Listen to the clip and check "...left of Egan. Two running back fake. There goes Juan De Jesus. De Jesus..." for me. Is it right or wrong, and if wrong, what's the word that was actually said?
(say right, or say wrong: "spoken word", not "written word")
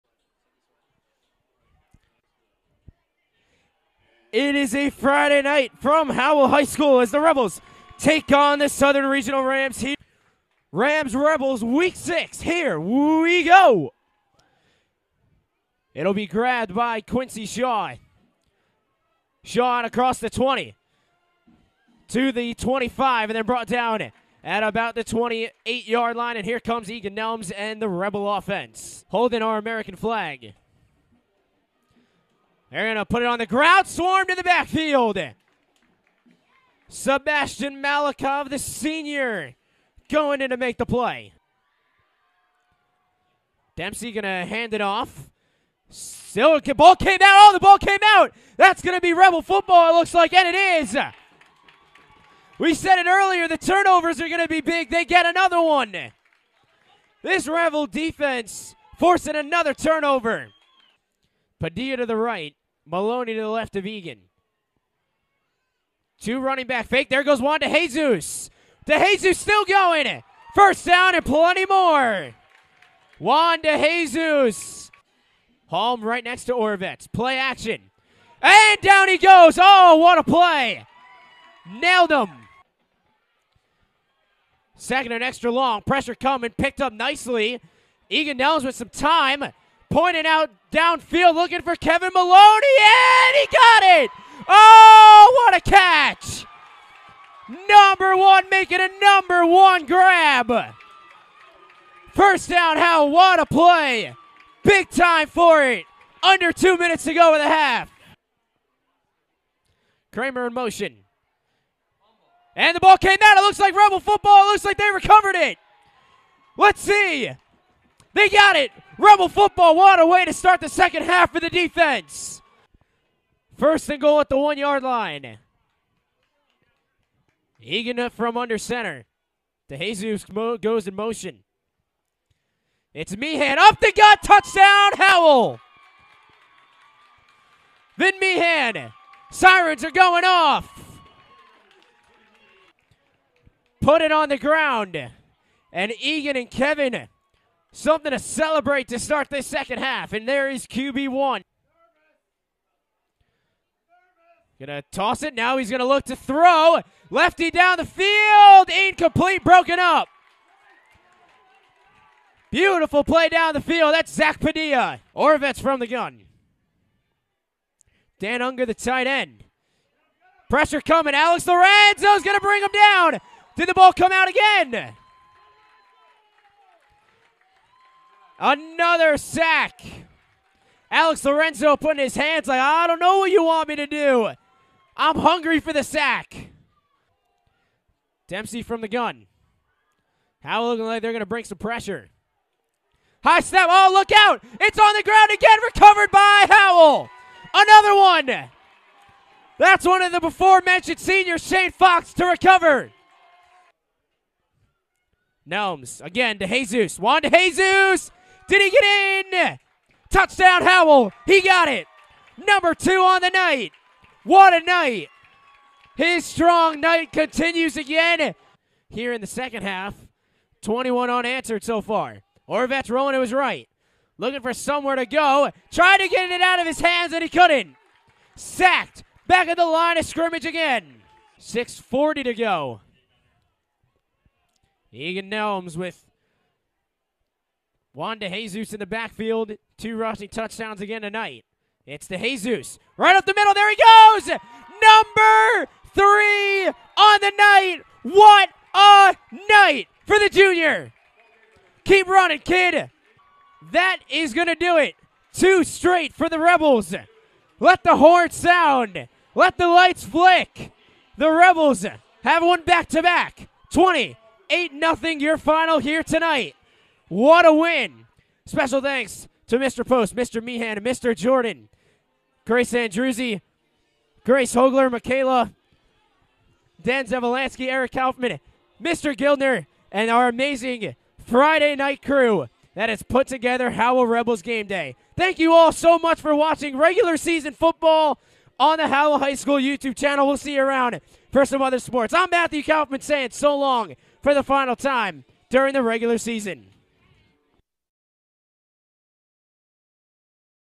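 right.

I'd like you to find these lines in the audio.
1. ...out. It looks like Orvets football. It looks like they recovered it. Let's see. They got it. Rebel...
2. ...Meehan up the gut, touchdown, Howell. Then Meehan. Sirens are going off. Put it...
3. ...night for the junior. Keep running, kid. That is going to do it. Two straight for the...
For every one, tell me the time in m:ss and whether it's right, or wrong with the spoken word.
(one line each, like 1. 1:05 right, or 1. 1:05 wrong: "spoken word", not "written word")
1. 1:53 wrong: "Rebel", not "Orvets"
2. 2:13 right
3. 4:09 right.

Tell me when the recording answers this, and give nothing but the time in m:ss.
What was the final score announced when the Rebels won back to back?
4:23.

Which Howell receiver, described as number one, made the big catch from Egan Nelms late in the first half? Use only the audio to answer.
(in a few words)
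Kevin Maloney.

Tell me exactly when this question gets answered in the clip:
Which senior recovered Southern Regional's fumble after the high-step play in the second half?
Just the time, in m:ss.
3:21.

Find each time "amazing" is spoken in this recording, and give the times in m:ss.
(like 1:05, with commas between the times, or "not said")
4:40.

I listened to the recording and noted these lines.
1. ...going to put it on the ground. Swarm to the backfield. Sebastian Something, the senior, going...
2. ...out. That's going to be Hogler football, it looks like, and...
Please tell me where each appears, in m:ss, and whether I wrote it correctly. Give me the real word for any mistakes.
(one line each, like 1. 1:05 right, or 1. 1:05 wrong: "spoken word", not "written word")
1. 0:32 wrong: "Malikov", not "Something"
2. 0:48 wrong: "Rebel", not "Hogler".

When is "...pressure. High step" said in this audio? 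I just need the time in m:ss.
3:11.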